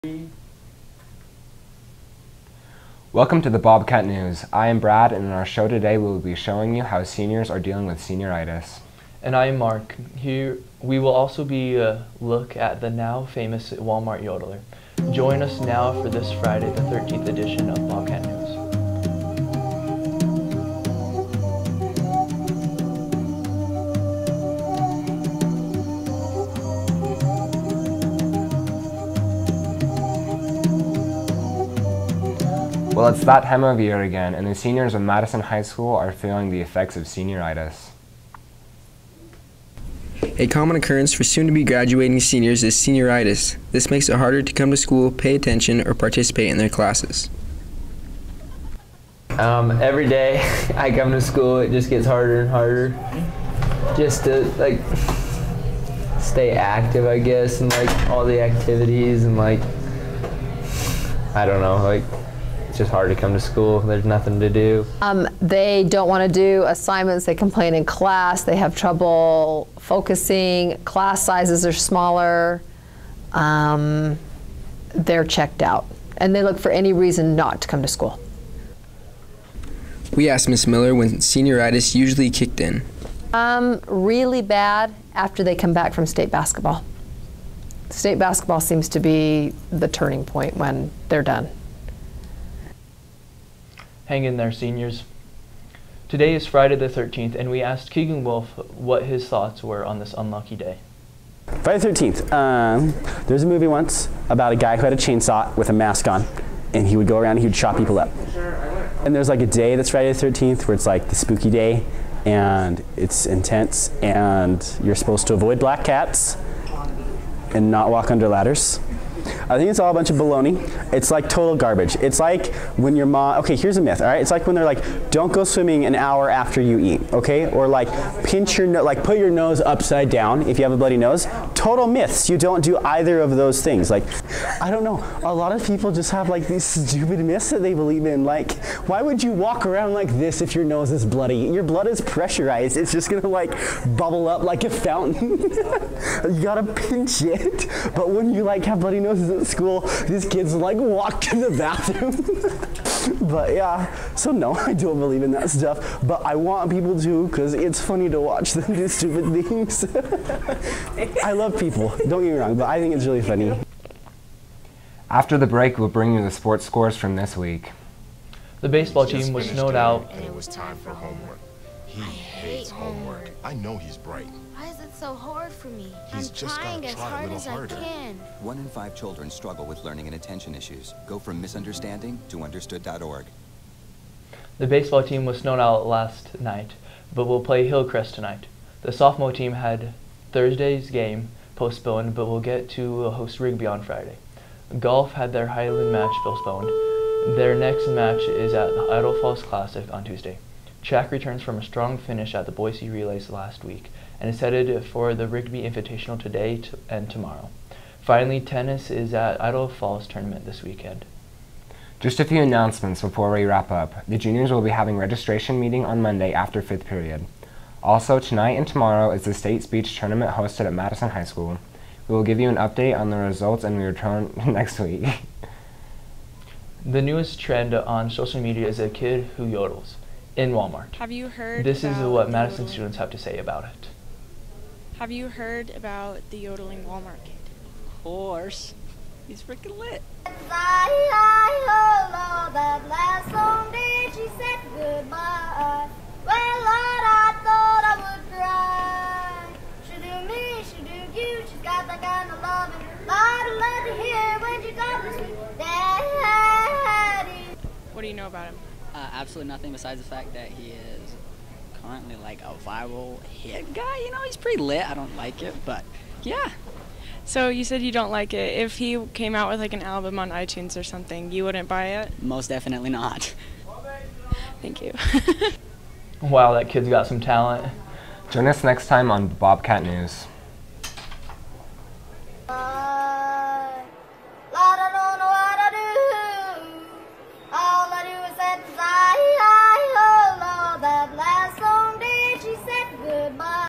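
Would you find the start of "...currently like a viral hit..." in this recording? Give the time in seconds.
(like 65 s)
261 s.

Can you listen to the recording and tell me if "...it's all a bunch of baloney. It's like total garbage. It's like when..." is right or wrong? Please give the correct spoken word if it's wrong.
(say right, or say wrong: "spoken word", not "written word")
right.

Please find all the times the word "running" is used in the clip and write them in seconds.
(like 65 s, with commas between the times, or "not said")
not said.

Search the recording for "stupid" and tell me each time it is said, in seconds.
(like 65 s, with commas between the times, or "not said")
136 s, 158 s.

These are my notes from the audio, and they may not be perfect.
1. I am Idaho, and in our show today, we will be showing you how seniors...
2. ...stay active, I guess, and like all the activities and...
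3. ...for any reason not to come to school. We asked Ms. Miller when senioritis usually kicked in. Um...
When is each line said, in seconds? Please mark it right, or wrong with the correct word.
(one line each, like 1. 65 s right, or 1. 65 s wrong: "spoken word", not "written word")
1. 4 s wrong: "Brad", not "Idaho"
2. 56 s right
3. 76 s right.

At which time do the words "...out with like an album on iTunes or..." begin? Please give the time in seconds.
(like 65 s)
269 s.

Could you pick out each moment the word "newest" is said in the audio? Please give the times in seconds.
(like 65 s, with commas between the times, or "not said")
227 s.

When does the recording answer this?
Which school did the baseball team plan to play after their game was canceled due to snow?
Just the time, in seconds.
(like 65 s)
187 s.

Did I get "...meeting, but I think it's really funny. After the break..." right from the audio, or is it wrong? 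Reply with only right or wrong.
wrong.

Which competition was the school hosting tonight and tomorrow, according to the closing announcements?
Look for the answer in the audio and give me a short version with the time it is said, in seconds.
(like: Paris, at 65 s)
State speech tournament, at 219 s.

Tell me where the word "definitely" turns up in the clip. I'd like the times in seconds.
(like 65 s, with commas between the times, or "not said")
272 s.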